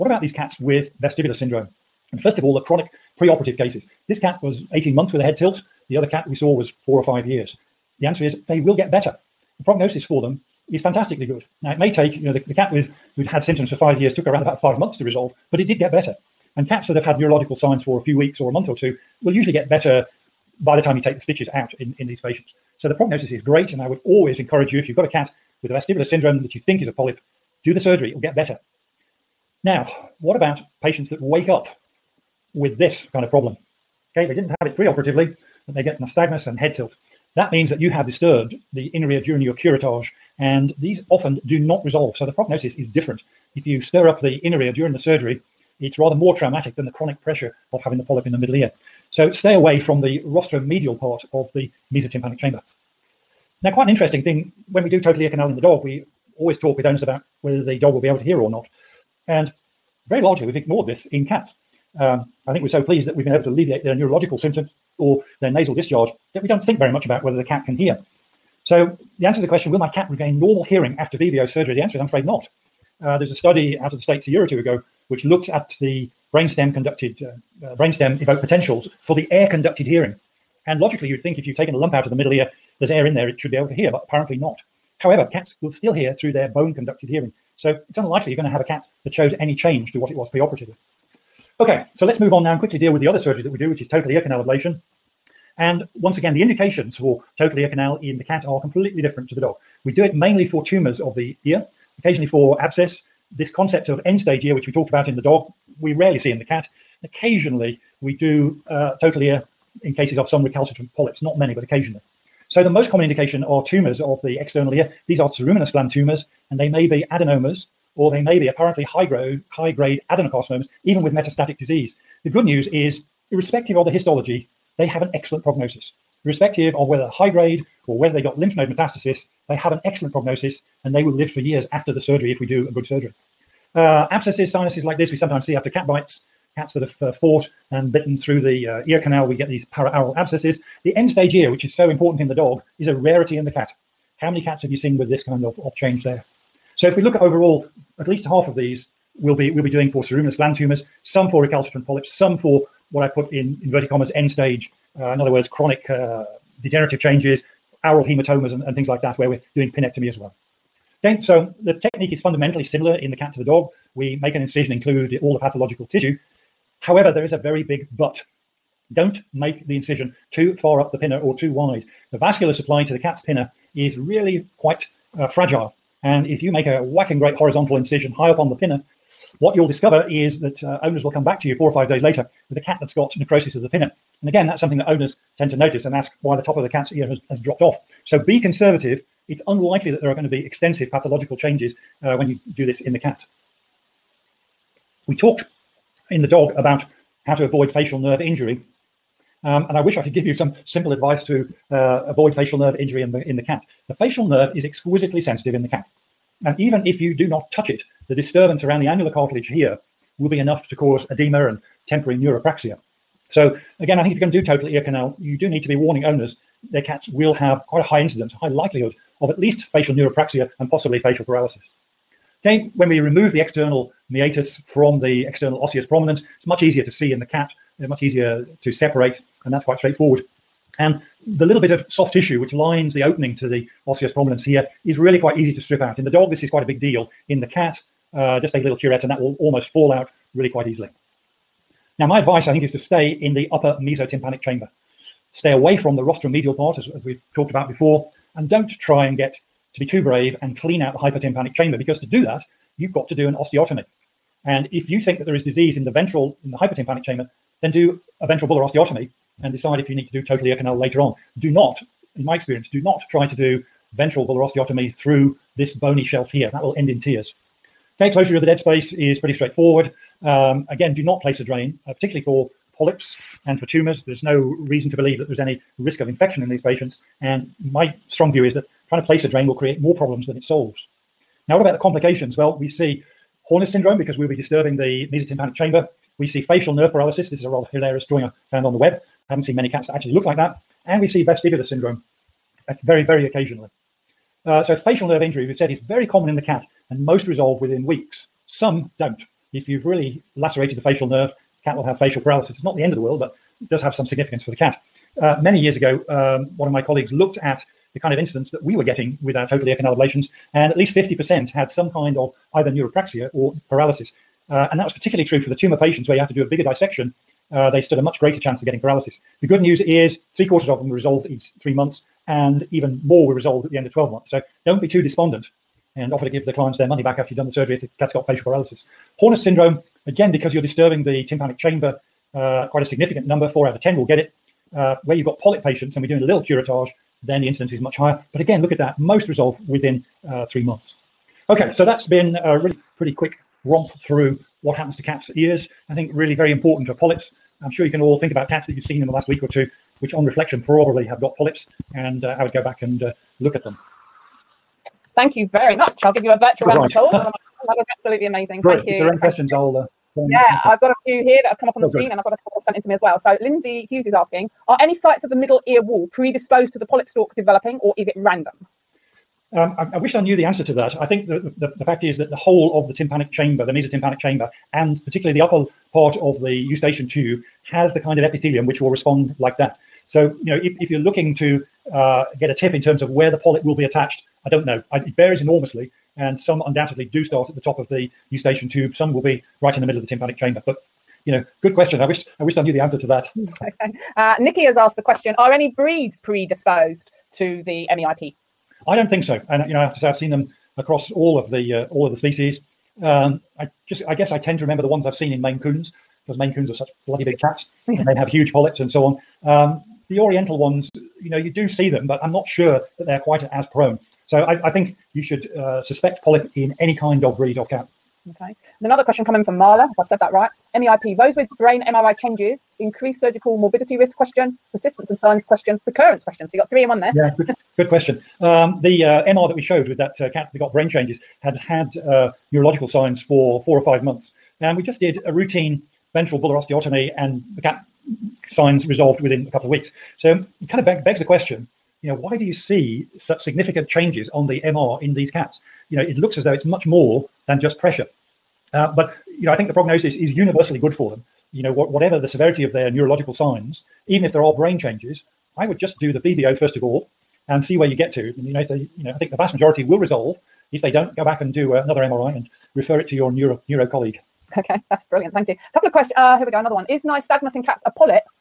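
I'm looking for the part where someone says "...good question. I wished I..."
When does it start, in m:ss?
6:31.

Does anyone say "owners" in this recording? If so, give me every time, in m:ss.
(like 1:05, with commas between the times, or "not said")
0:56, 3:00, 3:04, 3:36.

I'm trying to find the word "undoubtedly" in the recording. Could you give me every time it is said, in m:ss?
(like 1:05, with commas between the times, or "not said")
6:26.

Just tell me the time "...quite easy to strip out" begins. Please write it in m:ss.
3:55.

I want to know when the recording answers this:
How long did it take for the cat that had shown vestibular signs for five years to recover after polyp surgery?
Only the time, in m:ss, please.
0:14.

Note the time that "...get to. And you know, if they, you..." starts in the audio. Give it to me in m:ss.
7:37.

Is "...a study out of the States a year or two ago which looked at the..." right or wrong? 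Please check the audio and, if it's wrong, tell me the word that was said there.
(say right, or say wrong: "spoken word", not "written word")
right.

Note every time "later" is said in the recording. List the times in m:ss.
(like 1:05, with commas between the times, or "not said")
3:02, 4:20.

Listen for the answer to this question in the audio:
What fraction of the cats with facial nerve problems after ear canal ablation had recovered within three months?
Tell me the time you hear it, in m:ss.
5:20.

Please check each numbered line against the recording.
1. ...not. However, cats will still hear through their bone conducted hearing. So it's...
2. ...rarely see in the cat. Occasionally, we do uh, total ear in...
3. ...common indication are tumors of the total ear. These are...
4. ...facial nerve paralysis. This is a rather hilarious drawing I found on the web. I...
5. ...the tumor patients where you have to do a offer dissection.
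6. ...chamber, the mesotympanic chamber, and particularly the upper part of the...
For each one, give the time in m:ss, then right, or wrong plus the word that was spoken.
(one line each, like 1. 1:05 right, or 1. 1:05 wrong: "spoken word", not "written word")
1. 1:24 right
2. 1:45 right
3. 1:52 wrong: "external", not "total"
4. 4:46 right
5. 5:15 wrong: "bigger", not "offer"
6. 6:13 right.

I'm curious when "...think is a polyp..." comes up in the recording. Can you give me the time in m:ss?
0:26.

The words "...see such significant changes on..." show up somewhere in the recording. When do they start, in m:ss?
7:22.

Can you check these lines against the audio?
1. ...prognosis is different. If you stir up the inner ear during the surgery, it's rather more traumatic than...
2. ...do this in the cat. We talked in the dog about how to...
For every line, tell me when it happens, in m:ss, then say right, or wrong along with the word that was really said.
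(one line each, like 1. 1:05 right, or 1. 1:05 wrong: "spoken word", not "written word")
1. 0:42 right
2. 3:12 right.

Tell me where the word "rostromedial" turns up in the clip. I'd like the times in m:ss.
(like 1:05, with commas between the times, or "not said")
0:50, 4:06.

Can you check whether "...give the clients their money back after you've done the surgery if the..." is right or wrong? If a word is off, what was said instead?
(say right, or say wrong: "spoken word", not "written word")
right.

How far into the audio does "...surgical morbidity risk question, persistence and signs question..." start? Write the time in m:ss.
7:03.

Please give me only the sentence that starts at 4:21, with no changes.
Do not, in my experience, do not try to do ventral bulla osteotomy through this bony shelf here.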